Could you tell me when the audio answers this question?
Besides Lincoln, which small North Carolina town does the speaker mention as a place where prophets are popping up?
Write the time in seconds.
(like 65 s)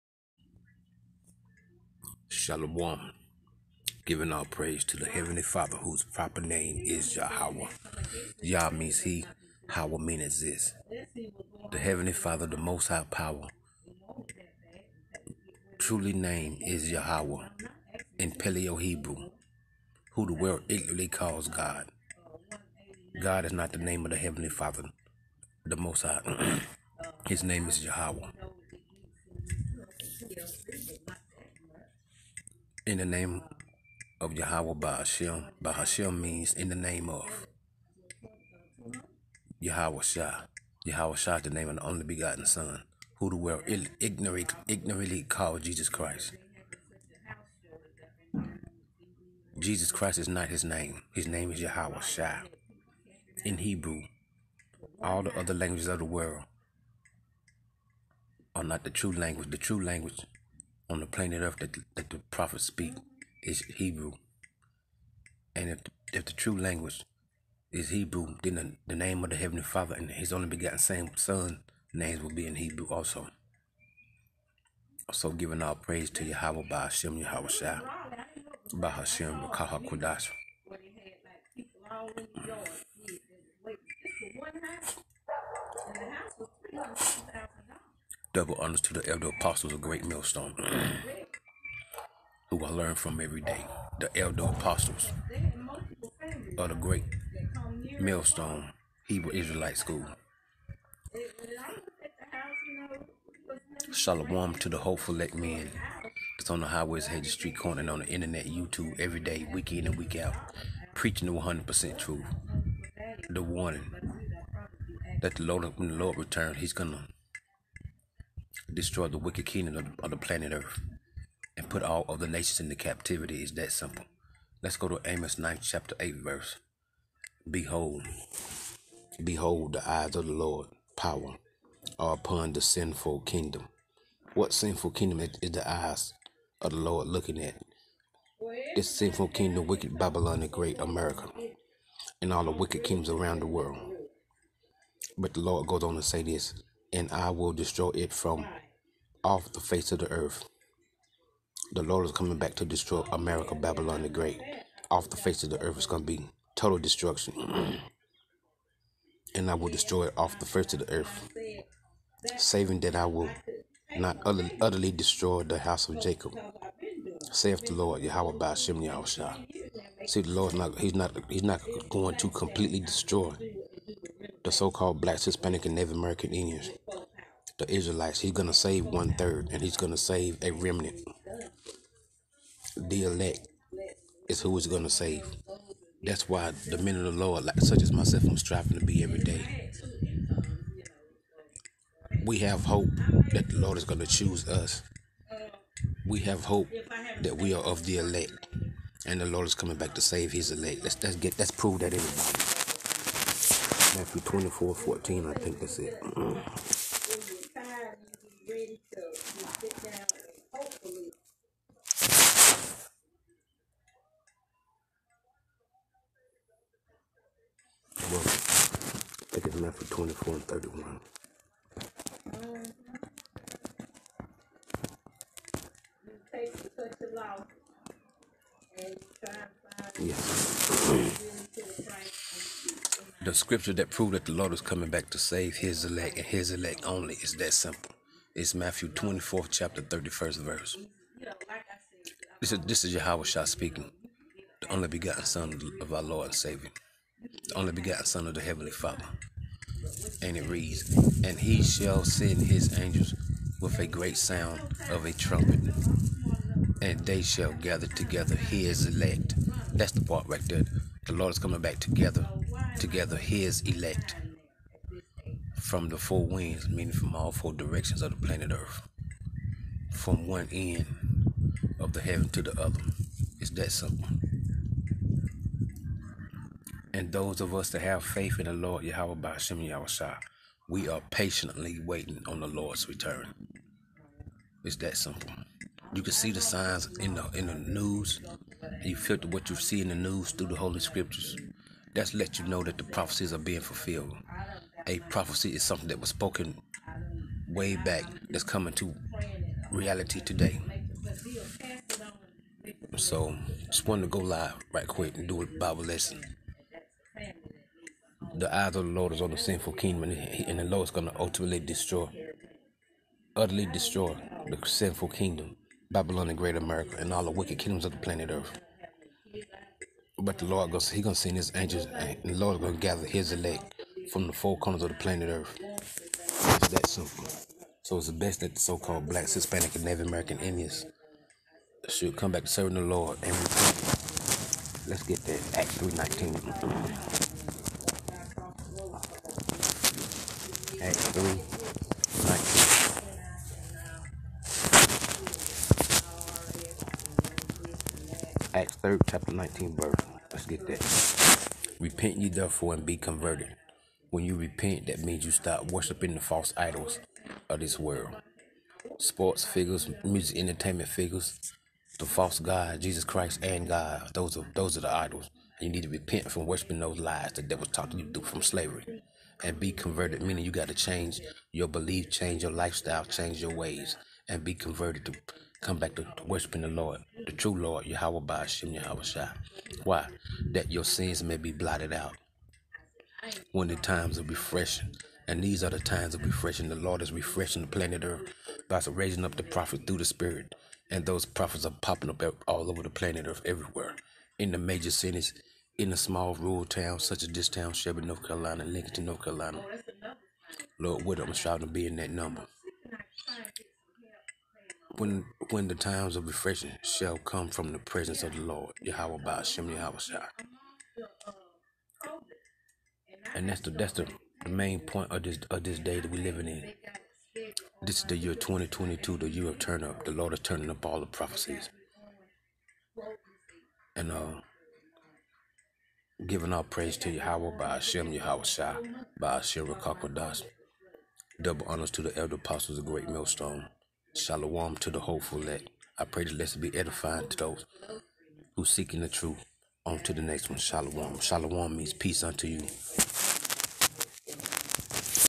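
397 s.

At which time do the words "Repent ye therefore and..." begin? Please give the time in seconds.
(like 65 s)
351 s.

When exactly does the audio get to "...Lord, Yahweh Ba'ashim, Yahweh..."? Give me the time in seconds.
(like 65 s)
377 s.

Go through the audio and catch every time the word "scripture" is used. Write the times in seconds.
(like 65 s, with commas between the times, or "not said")
233 s, 290 s.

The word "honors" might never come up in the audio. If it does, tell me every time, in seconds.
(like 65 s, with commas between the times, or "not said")
88 s, 431 s.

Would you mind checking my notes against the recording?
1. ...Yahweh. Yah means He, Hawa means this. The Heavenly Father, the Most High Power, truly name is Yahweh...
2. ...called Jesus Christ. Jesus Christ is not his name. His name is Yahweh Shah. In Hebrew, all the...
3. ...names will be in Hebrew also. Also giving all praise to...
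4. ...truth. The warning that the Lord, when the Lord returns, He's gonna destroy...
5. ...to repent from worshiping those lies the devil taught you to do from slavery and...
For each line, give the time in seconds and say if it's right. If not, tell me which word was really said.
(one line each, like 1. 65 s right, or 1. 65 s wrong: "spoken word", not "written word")
1. 7 s right
2. 45 s right
3. 71 s right
4. 111 s right
5. 365 s right.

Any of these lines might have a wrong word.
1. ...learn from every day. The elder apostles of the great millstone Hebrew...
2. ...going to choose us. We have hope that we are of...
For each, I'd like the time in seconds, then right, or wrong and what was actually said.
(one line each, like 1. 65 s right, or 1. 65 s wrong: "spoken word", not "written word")
1. 92 s right
2. 193 s right.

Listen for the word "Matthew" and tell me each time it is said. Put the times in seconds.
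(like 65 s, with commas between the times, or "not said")
203 s, 238 s.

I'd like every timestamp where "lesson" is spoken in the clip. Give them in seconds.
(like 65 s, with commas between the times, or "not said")
305 s, 436 s.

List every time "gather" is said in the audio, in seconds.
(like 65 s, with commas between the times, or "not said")
257 s, 322 s.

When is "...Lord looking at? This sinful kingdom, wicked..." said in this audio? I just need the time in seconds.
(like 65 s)
136 s.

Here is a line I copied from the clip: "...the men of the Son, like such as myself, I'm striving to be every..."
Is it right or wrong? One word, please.
wrong.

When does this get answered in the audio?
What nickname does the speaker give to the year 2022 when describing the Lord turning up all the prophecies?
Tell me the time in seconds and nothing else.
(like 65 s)
419 s.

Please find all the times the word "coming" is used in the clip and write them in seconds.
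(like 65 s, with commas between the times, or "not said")
152 s, 199 s, 234 s, 261 s, 298 s.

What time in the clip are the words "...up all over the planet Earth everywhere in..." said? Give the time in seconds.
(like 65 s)
392 s.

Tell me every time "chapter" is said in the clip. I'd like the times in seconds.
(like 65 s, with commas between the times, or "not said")
125 s, 239 s, 349 s.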